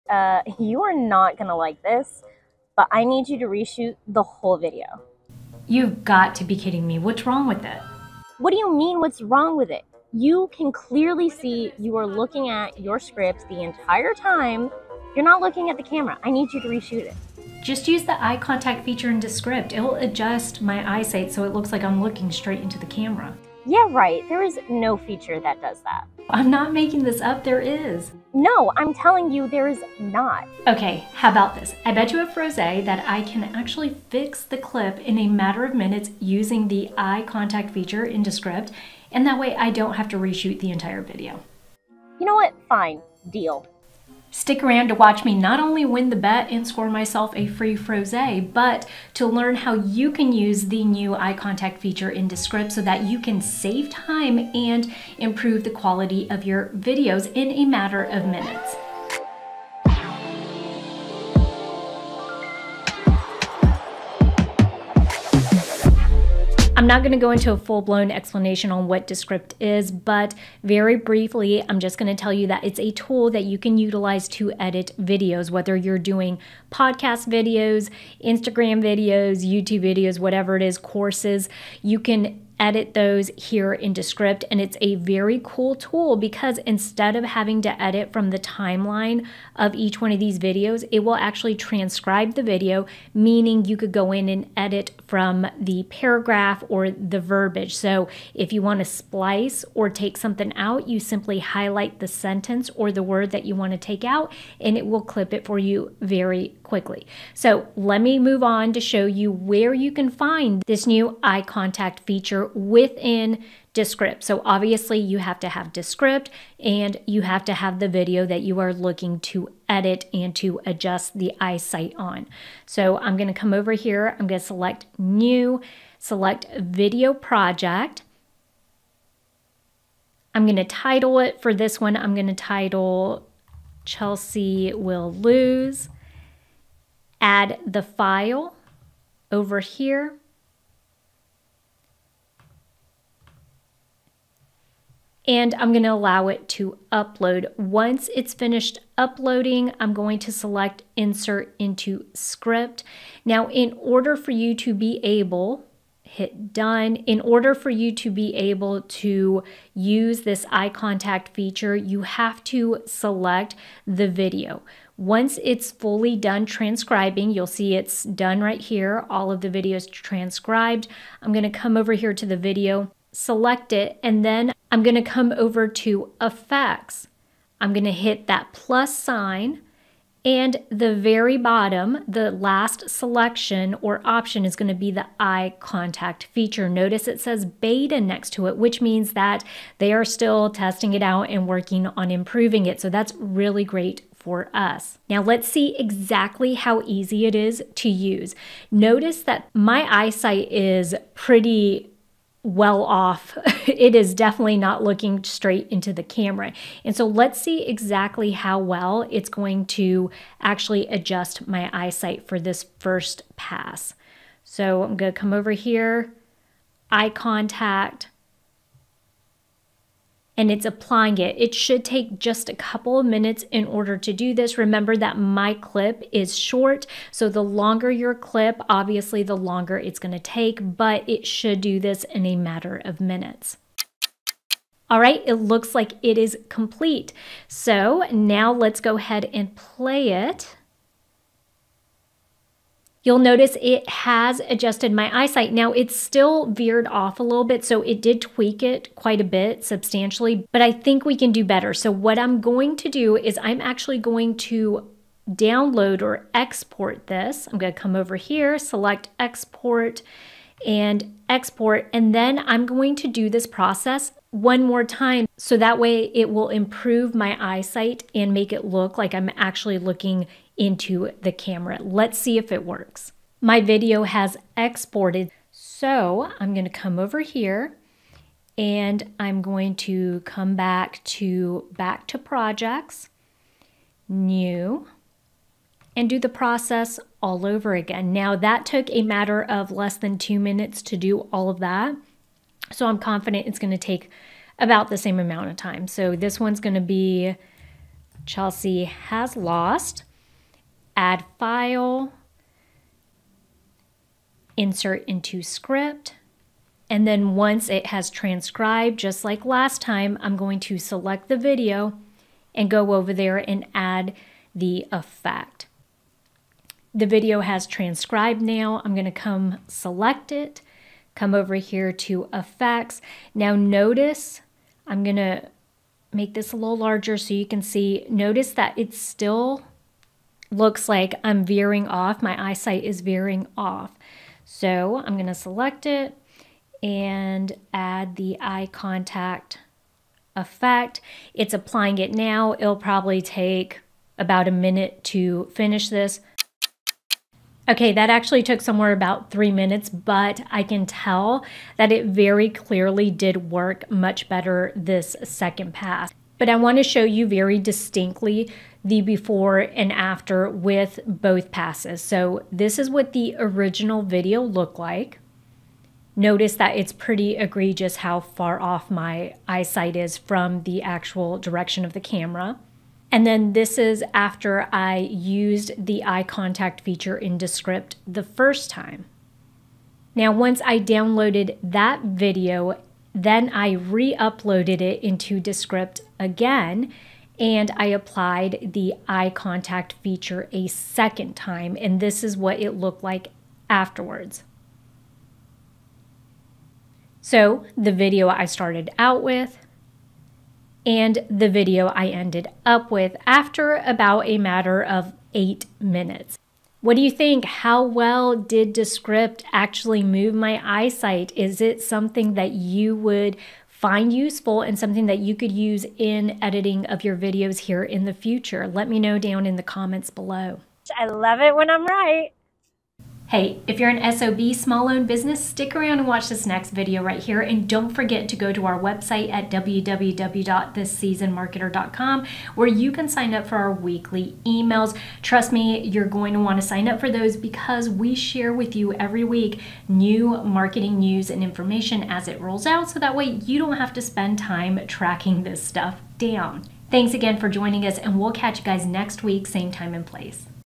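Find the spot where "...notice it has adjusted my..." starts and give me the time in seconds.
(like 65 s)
243 s.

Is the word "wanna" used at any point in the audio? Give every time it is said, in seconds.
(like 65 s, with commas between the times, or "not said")
356 s.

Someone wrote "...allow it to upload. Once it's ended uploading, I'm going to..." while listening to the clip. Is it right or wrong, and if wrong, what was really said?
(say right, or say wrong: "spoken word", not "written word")
wrong: "finished", not "ended".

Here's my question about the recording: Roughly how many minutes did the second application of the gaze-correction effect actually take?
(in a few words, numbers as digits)
3.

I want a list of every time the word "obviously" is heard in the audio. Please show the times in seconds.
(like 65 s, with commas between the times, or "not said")
114 s, 228 s.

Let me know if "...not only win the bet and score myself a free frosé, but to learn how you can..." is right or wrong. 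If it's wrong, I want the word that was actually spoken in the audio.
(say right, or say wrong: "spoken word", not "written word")
right.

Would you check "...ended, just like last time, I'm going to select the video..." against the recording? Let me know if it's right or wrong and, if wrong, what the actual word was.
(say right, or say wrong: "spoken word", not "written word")
wrong: "transcribed", not "ended".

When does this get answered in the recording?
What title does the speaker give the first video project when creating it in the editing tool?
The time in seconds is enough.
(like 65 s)
133 s.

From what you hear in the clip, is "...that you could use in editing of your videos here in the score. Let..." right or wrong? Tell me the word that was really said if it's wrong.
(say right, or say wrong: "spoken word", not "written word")
wrong: "future", not "score".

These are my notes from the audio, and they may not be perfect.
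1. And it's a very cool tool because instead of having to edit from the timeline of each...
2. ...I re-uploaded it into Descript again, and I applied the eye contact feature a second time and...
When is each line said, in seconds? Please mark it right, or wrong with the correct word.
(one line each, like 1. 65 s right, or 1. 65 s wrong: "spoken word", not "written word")
1. 84 s right
2. 383 s right.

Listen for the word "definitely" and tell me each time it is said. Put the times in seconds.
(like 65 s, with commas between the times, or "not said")
204 s.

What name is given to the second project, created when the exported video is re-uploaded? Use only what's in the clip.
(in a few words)
Chelsea has lost.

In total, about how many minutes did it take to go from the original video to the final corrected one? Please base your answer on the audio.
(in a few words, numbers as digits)
8.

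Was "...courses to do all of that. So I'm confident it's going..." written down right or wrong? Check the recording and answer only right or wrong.
wrong.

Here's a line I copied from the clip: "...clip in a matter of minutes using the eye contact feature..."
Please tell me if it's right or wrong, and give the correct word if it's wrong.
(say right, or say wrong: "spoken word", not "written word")
right.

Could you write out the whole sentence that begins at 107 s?
So let me move on to show you where you can find this new eye contact feature within Descript.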